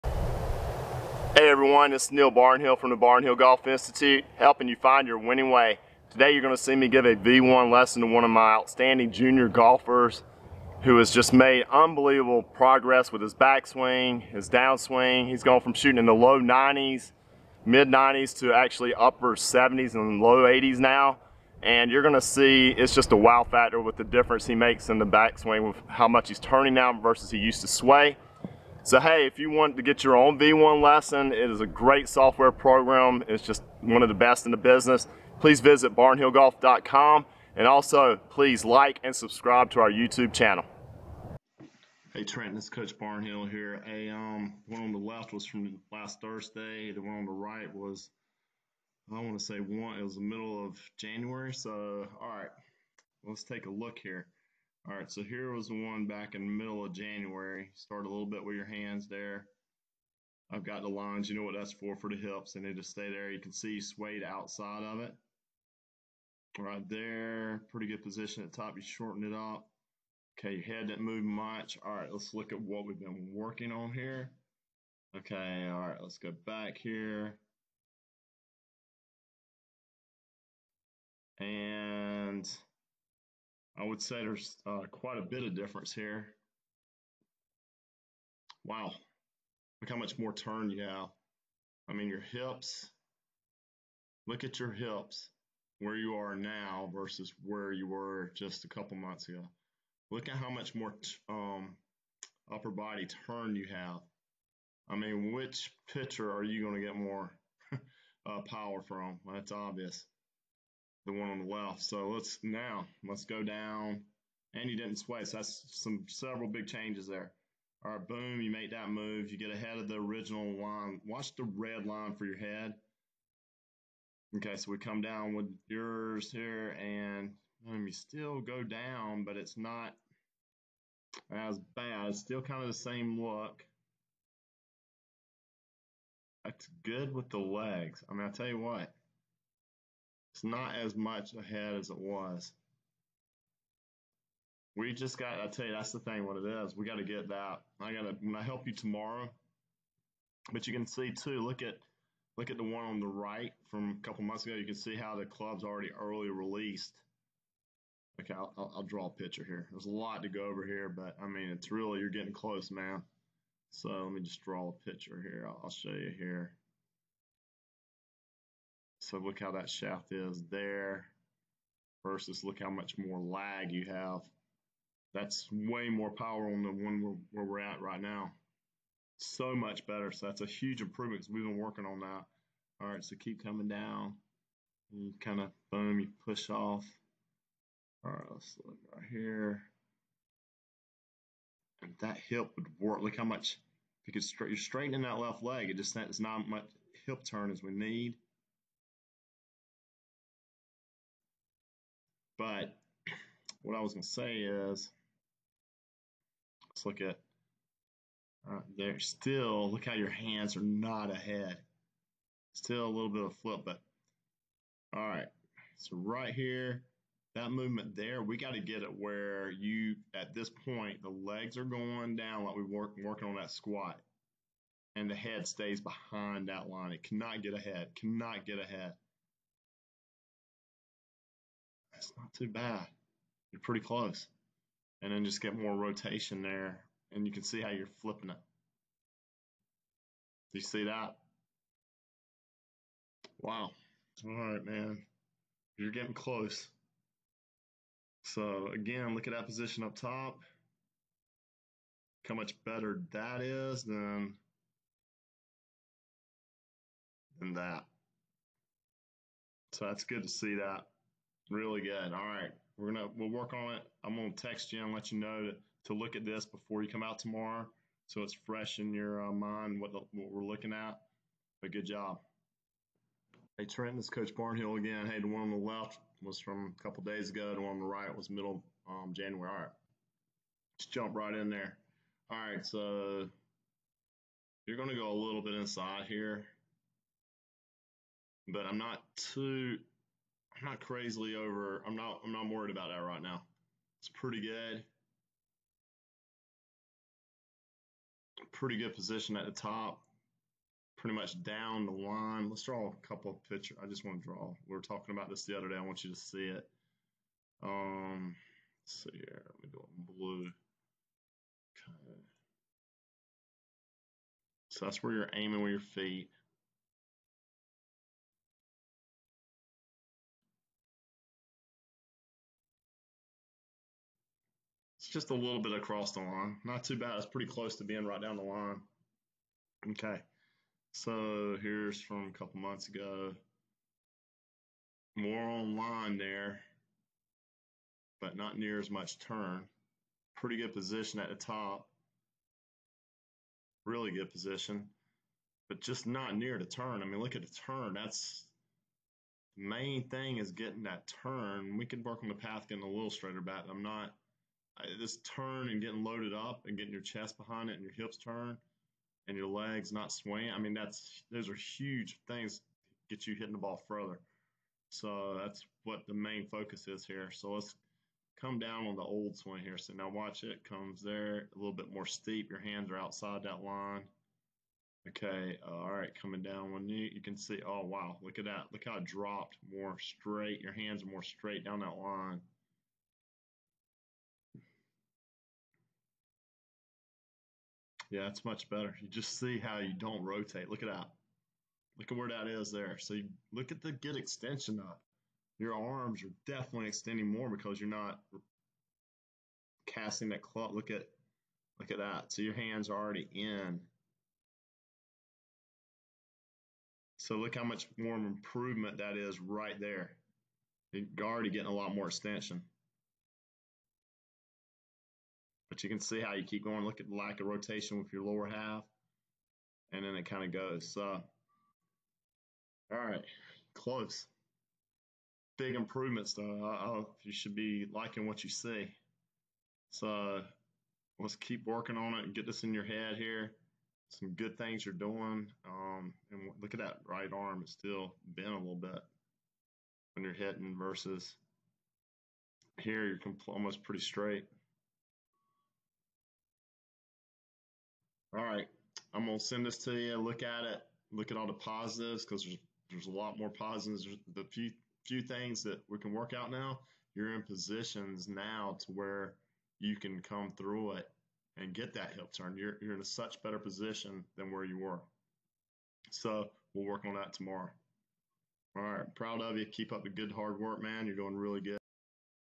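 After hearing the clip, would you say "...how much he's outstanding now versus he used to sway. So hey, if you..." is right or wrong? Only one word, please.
wrong.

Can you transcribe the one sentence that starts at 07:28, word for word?
All right, I'm gonna send this to you.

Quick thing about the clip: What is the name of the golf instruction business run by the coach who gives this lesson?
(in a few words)
Barnhill Golf Institute.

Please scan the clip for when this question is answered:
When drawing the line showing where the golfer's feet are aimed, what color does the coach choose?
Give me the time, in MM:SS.
05:10.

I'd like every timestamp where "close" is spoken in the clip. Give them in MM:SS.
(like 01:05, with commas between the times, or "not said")
02:42, 03:53, 04:06, 05:27, 07:03.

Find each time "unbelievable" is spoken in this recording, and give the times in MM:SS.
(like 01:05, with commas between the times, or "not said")
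00:11.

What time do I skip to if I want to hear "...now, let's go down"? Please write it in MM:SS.
01:52.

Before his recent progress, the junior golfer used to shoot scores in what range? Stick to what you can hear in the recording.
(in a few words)
low 90s, mid 90s.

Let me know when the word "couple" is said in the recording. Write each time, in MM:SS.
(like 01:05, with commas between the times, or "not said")
01:38, 02:34, 04:36, 05:03, 05:32.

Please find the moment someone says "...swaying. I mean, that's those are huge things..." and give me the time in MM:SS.
06:00.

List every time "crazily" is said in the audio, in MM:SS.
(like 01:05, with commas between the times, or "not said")
04:50.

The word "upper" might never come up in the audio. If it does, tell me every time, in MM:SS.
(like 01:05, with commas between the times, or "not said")
00:18, 01:42.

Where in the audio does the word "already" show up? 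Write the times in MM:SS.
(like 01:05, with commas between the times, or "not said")
02:35, 06:42, 06:51.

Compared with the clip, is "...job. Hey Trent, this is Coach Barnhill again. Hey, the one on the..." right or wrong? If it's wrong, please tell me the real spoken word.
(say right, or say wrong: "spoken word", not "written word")
right.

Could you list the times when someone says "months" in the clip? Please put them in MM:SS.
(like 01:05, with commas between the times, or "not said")
01:38, 02:34, 05:32.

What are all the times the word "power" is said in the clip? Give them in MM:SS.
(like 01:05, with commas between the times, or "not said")
01:48, 02:56.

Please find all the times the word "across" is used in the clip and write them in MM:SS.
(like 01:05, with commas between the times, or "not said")
05:25.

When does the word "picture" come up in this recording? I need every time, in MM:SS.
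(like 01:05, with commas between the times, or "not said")
02:39, 02:44, 05:03.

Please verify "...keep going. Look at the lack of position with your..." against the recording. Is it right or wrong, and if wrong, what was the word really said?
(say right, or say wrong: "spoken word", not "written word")
wrong: "rotation", not "position".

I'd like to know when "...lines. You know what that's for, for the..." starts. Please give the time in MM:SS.
01:00.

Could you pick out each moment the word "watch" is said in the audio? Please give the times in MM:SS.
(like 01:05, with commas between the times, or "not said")
02:01, 06:10.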